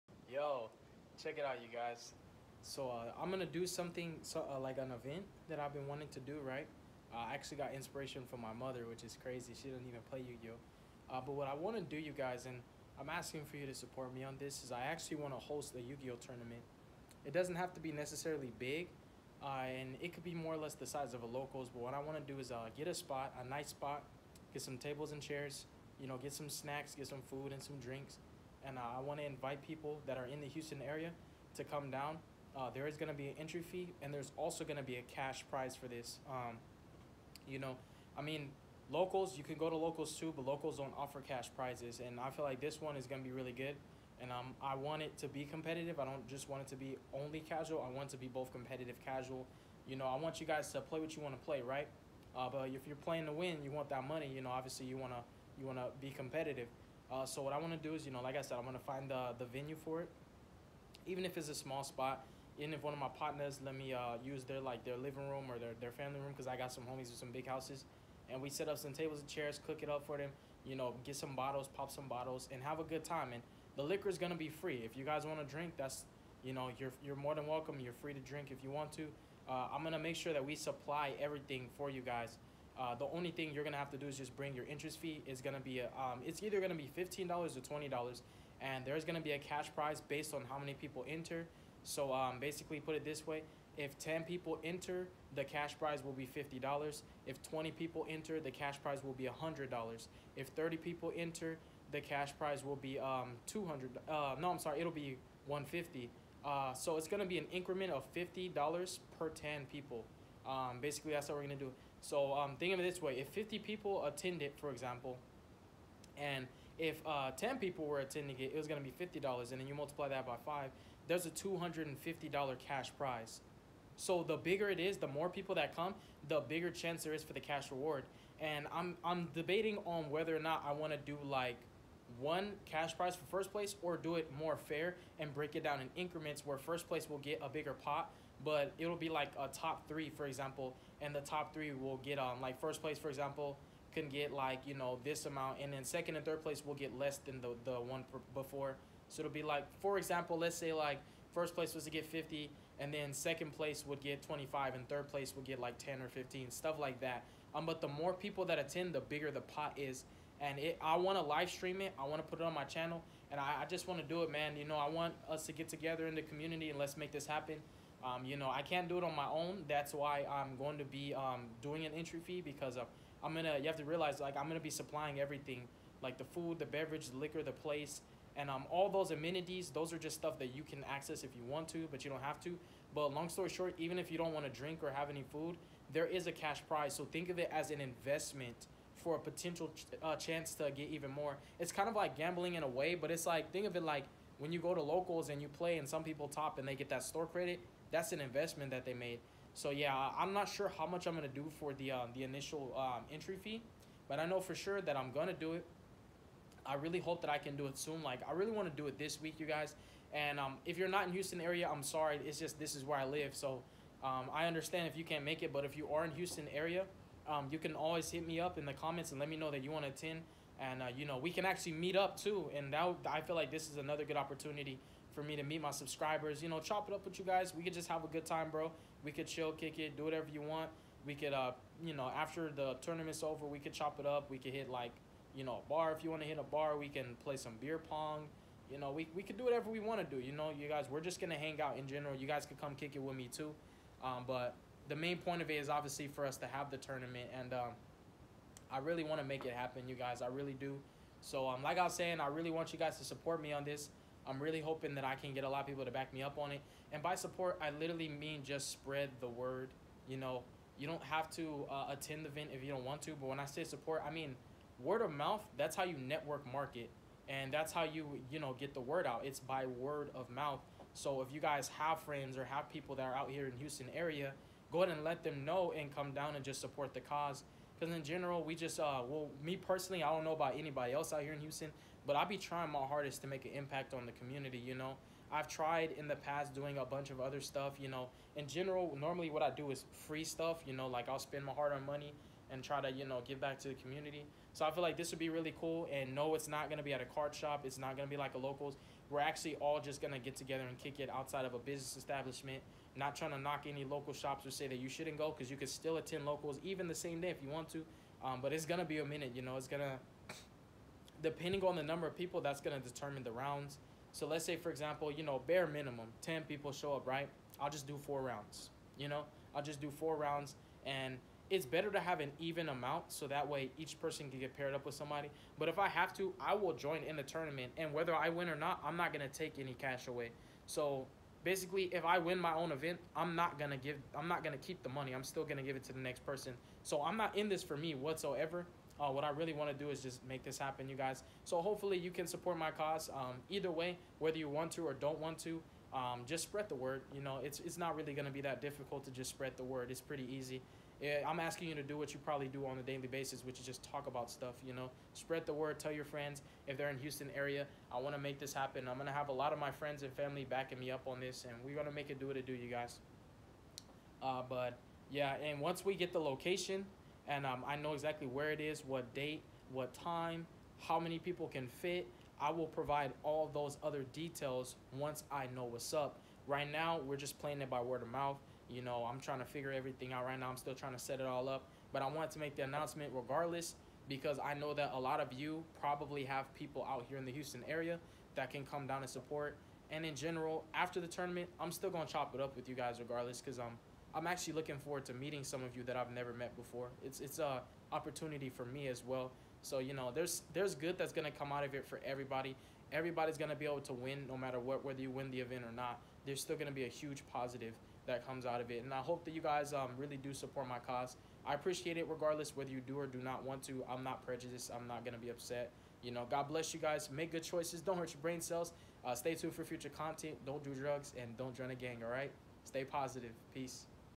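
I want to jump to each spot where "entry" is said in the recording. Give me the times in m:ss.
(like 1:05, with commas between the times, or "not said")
0:33, 2:51, 3:23.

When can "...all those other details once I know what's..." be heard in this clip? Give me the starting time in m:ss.
6:13.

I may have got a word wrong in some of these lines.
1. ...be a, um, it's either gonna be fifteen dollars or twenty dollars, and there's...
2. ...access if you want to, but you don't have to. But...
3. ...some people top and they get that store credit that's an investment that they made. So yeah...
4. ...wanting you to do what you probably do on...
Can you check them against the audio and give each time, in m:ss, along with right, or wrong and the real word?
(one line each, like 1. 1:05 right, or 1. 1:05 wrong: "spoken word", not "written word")
1. 1:25 right
2. 3:00 right
3. 3:15 right
4. 5:51 wrong: "asking", not "wanting".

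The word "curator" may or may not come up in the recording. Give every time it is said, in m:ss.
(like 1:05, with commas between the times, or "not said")
not said.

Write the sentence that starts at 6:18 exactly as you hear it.
You know, I'm trying to figure everything out right now.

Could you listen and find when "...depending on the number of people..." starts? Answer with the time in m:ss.
5:11.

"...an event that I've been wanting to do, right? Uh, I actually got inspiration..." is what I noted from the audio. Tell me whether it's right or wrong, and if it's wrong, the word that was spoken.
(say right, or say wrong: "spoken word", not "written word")
right.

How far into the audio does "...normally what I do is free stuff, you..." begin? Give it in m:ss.
4:48.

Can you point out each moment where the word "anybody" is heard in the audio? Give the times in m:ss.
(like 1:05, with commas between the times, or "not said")
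4:40.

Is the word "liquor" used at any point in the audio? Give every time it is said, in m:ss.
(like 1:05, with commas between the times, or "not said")
1:13, 2:57.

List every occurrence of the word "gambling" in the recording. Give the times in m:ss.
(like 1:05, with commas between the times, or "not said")
3:12.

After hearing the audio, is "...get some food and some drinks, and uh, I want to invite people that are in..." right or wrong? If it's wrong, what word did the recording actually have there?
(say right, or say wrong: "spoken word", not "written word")
right.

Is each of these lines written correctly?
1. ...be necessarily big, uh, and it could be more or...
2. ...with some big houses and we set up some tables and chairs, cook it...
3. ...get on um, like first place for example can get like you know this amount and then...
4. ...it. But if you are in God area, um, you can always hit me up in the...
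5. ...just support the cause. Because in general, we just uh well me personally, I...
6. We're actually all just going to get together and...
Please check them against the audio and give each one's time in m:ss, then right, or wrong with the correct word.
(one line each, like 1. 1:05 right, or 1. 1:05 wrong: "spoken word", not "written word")
1. 0:17 right
2. 1:07 right
3. 2:21 right
4. 3:35 wrong: "Houston", not "God"
5. 4:36 right
6. 4:59 right.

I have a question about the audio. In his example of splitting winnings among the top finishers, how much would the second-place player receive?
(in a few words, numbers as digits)
$25.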